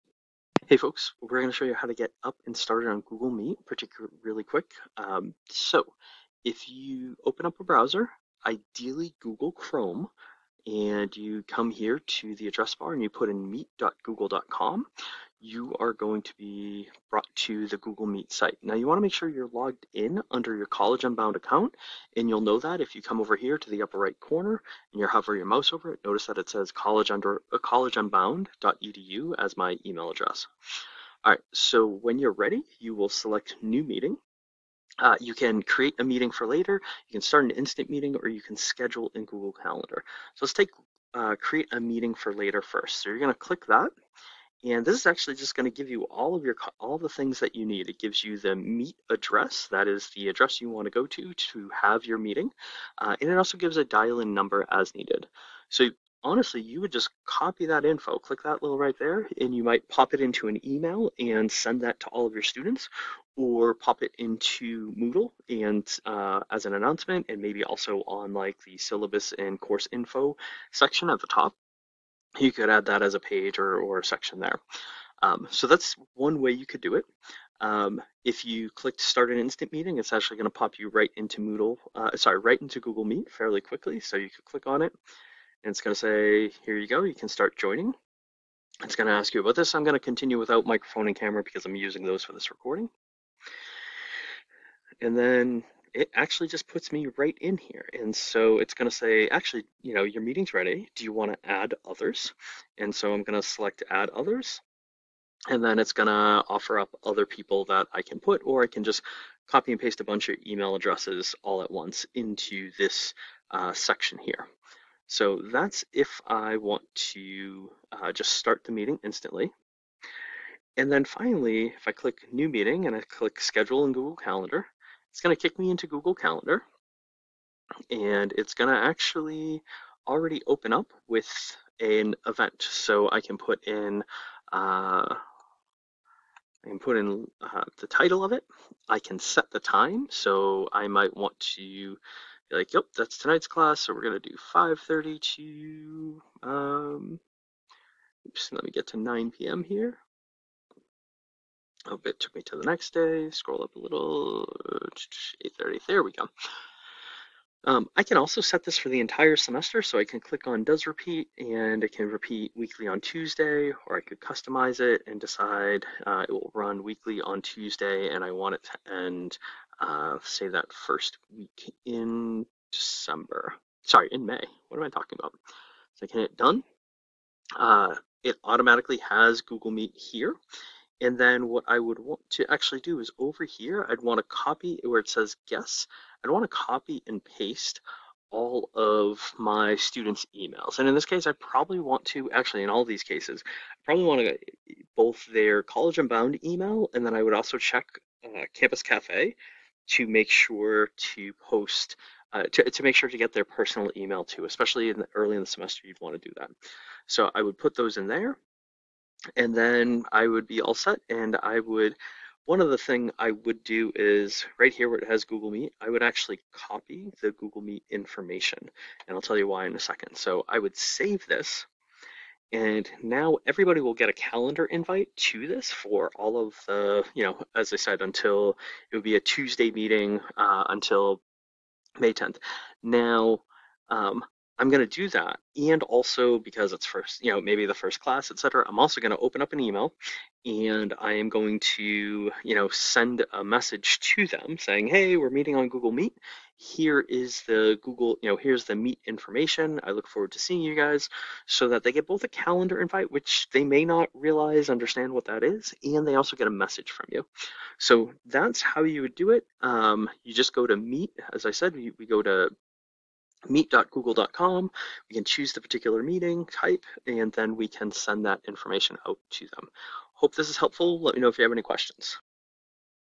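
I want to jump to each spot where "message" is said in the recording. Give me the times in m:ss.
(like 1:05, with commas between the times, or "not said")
4:03, 4:16.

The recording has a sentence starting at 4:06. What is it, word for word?
Here is the Google, you know, here's the Meet information.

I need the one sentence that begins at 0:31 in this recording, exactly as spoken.
All right, so when you're ready, you will select new meeting.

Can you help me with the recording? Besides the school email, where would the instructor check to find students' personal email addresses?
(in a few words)
Campus Cafe.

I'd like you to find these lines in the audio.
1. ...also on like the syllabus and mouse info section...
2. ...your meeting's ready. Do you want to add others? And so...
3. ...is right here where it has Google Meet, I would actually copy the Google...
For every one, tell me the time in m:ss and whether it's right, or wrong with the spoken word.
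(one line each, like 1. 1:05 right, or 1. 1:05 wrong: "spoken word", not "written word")
1. 1:07 wrong: "course", not "mouse"
2. 1:40 right
3. 3:33 right.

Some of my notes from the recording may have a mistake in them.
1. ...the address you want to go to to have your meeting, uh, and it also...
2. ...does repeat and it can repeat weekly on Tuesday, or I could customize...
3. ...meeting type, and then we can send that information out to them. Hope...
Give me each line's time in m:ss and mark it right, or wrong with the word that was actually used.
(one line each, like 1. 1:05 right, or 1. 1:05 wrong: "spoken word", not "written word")
1. 0:50 right
2. 2:40 right
3. 4:26 right.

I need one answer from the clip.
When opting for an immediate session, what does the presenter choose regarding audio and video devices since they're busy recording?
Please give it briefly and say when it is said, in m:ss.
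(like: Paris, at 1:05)
Continue without microphone and camera, at 1:29.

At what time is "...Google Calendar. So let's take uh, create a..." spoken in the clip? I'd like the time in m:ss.
0:39.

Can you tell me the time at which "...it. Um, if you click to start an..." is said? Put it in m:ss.
1:16.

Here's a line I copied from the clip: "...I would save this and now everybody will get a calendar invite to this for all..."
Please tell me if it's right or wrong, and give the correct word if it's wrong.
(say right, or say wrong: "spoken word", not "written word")
right.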